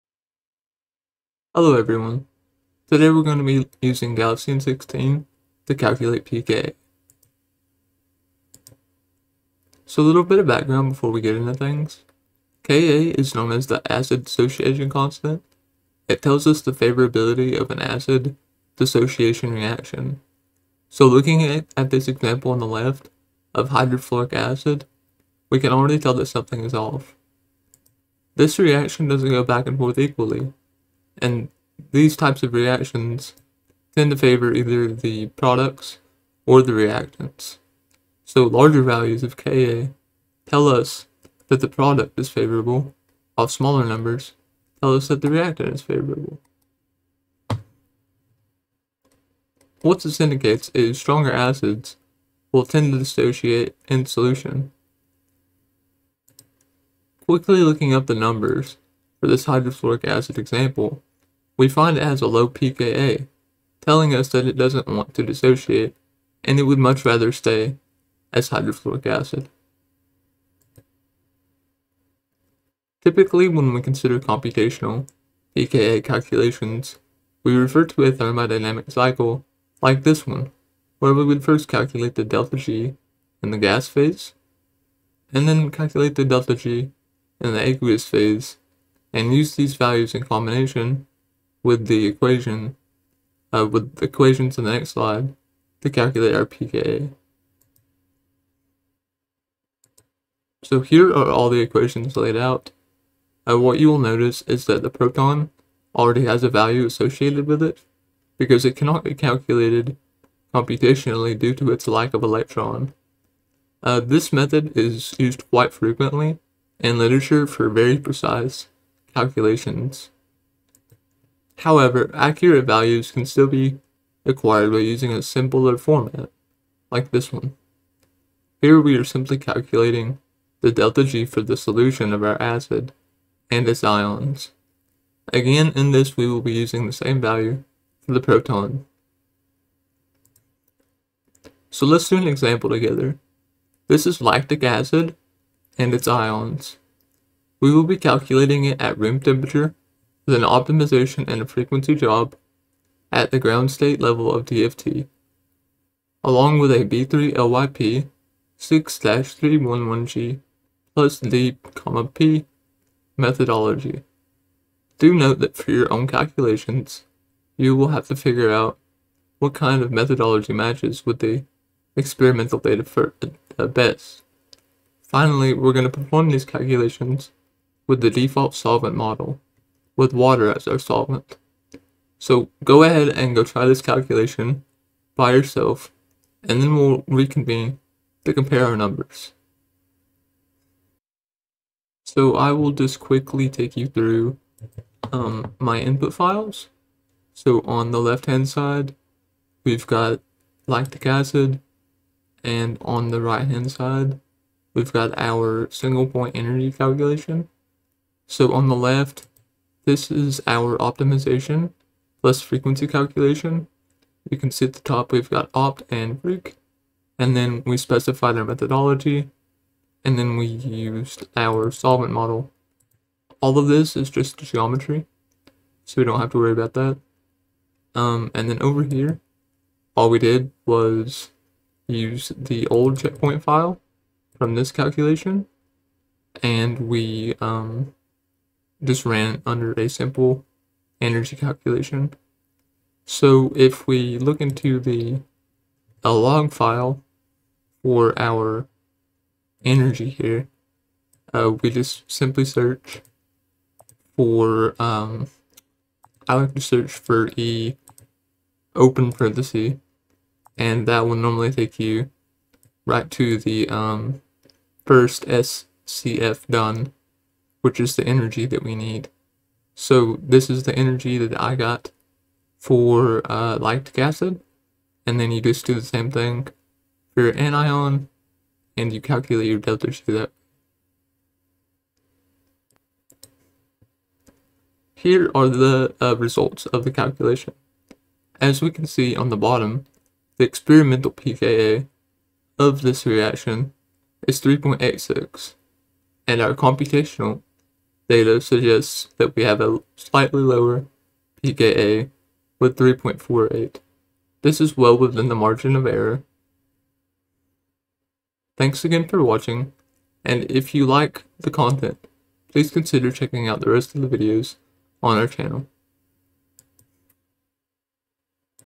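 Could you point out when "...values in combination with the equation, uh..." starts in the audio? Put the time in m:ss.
1:29.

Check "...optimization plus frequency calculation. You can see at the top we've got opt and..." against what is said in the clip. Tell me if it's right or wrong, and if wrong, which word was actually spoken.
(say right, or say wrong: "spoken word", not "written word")
right.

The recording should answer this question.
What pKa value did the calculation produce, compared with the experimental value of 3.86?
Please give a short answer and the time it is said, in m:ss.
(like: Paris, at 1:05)
3.48, at 5:02.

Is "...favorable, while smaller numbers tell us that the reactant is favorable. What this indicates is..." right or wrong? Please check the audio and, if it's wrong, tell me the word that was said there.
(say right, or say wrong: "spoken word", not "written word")
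right.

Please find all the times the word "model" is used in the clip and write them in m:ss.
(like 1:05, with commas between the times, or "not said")
2:58, 3:42.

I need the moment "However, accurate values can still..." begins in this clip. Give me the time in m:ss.
2:01.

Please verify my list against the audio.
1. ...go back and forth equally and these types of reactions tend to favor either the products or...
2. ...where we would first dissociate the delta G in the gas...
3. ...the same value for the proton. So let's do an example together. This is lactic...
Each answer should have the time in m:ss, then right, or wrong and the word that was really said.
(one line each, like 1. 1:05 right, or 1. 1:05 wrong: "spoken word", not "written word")
1. 0:29 right
2. 1:20 wrong: "calculate", not "dissociate"
3. 2:16 right.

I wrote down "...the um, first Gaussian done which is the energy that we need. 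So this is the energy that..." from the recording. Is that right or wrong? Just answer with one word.
wrong.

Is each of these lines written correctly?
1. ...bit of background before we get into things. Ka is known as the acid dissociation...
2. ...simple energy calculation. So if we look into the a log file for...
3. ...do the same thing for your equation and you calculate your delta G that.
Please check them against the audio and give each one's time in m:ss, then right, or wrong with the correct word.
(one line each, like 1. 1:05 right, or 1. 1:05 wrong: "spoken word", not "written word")
1. 0:10 right
2. 3:59 right
3. 4:35 wrong: "anion", not "equation".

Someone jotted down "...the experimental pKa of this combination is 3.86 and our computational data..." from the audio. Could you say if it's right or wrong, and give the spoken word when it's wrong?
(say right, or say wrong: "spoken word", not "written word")
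wrong: "reaction", not "combination".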